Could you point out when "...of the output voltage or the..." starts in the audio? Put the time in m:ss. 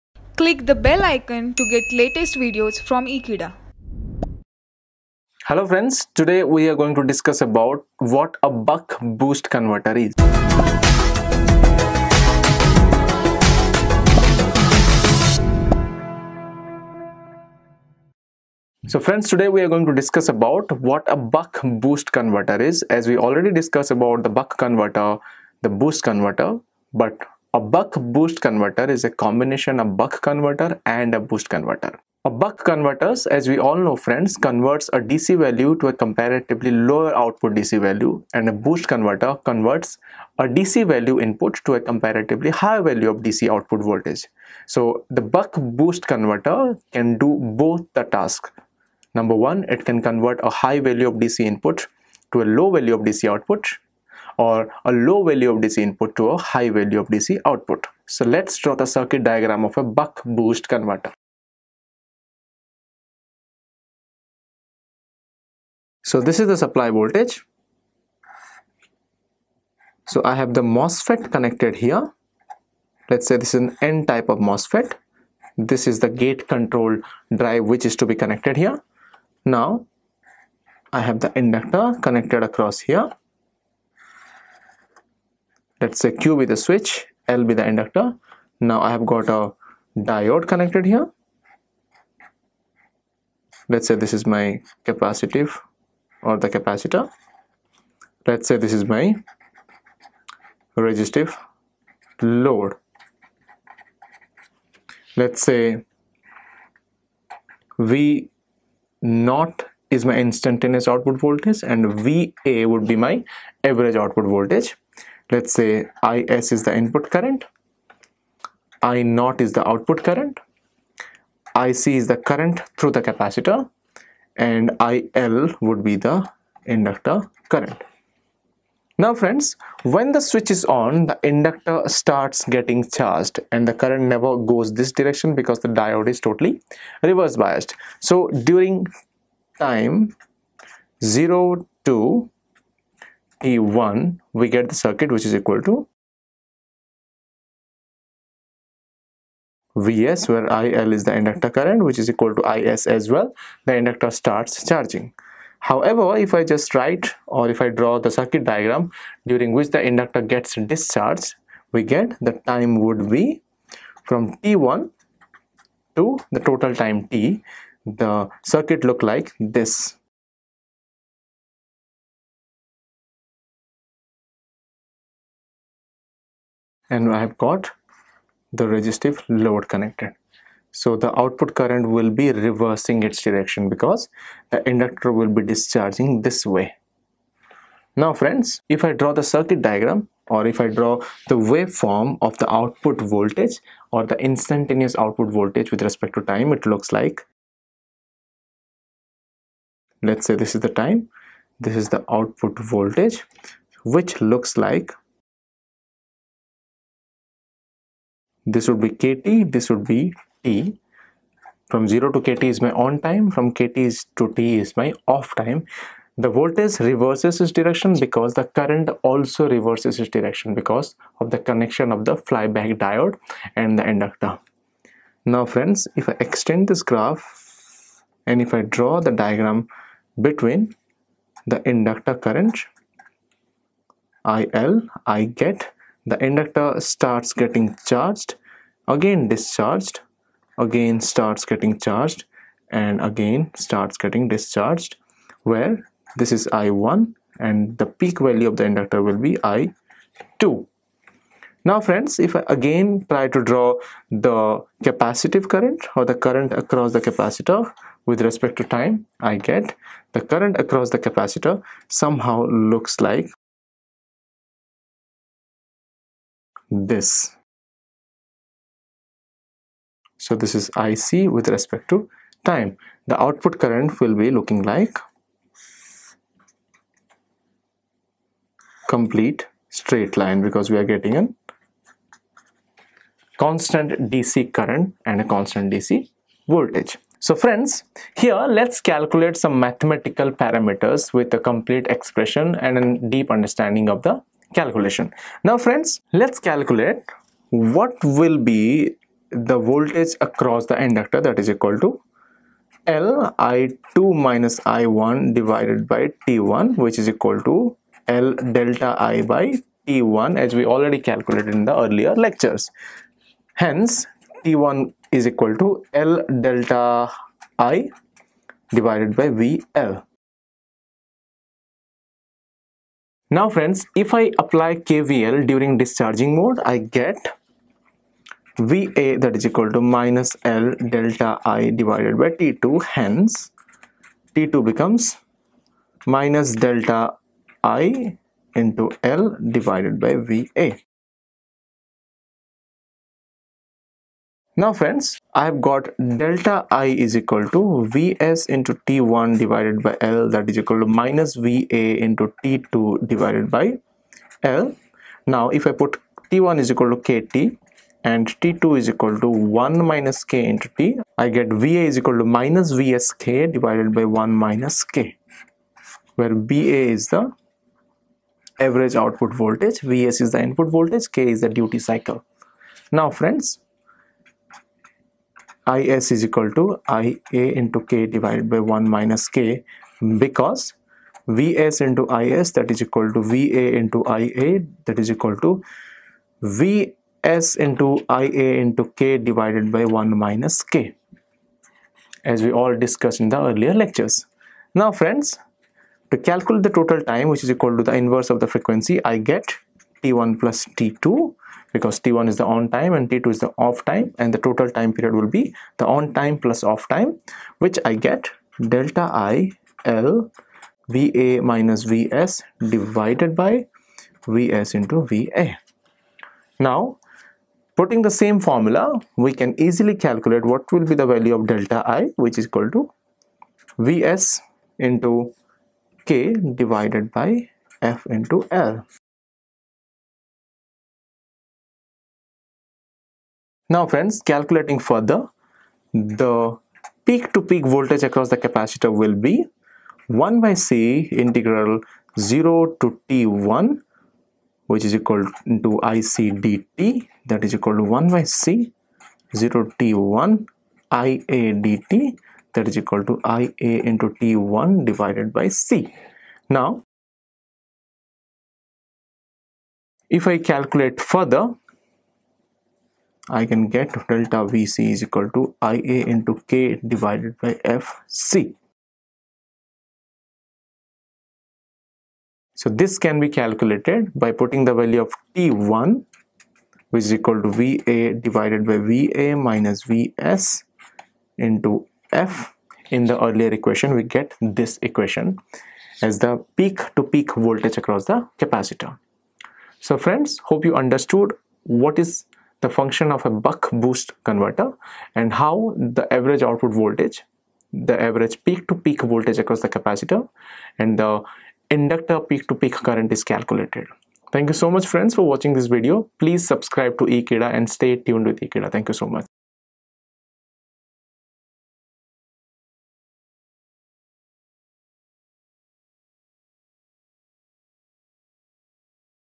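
3:12.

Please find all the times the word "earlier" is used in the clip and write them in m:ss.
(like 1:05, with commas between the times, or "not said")
5:11, 6:33, 8:03.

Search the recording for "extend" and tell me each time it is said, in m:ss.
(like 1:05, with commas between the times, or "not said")
3:46.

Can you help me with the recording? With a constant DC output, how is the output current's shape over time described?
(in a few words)
complete straight line.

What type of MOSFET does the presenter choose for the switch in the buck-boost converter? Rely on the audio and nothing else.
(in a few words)
N type.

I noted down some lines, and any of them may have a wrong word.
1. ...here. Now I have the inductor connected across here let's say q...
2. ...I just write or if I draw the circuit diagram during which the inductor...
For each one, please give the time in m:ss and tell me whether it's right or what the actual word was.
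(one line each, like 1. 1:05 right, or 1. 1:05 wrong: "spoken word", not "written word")
1. 1:18 right
2. 2:36 right.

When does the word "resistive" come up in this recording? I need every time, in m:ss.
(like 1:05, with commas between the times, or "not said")
1:40, 2:58.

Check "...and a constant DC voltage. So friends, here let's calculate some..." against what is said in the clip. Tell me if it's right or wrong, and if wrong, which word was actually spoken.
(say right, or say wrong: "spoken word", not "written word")
right.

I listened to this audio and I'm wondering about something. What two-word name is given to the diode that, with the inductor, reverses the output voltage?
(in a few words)
flyback diode.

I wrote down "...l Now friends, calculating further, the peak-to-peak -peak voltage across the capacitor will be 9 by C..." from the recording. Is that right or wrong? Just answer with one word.
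wrong.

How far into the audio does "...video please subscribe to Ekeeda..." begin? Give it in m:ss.
8:25.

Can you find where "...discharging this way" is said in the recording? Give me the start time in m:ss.
3:05.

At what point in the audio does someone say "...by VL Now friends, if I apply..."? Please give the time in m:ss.
5:19.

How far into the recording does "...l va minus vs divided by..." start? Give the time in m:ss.
6:49.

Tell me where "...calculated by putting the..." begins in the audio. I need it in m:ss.
7:53.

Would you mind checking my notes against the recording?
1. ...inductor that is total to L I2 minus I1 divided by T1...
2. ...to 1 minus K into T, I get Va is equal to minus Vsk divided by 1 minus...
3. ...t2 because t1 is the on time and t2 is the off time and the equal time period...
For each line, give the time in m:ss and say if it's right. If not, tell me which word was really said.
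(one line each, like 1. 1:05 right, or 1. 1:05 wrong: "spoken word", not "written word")
1. 5:00 wrong: "equal", not "total"
2. 5:59 right
3. 6:40 wrong: "total", not "equal".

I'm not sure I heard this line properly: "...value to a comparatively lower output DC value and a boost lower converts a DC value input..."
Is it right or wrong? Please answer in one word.
wrong.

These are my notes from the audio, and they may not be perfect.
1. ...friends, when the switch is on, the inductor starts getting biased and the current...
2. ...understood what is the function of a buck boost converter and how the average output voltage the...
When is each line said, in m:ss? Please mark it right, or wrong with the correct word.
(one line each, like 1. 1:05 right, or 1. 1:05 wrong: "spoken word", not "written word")
1. 2:09 wrong: "charged", not "biased"
2. 8:10 right.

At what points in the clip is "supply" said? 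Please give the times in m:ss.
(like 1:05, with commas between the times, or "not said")
1:06.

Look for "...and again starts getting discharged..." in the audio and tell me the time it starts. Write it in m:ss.
4:02.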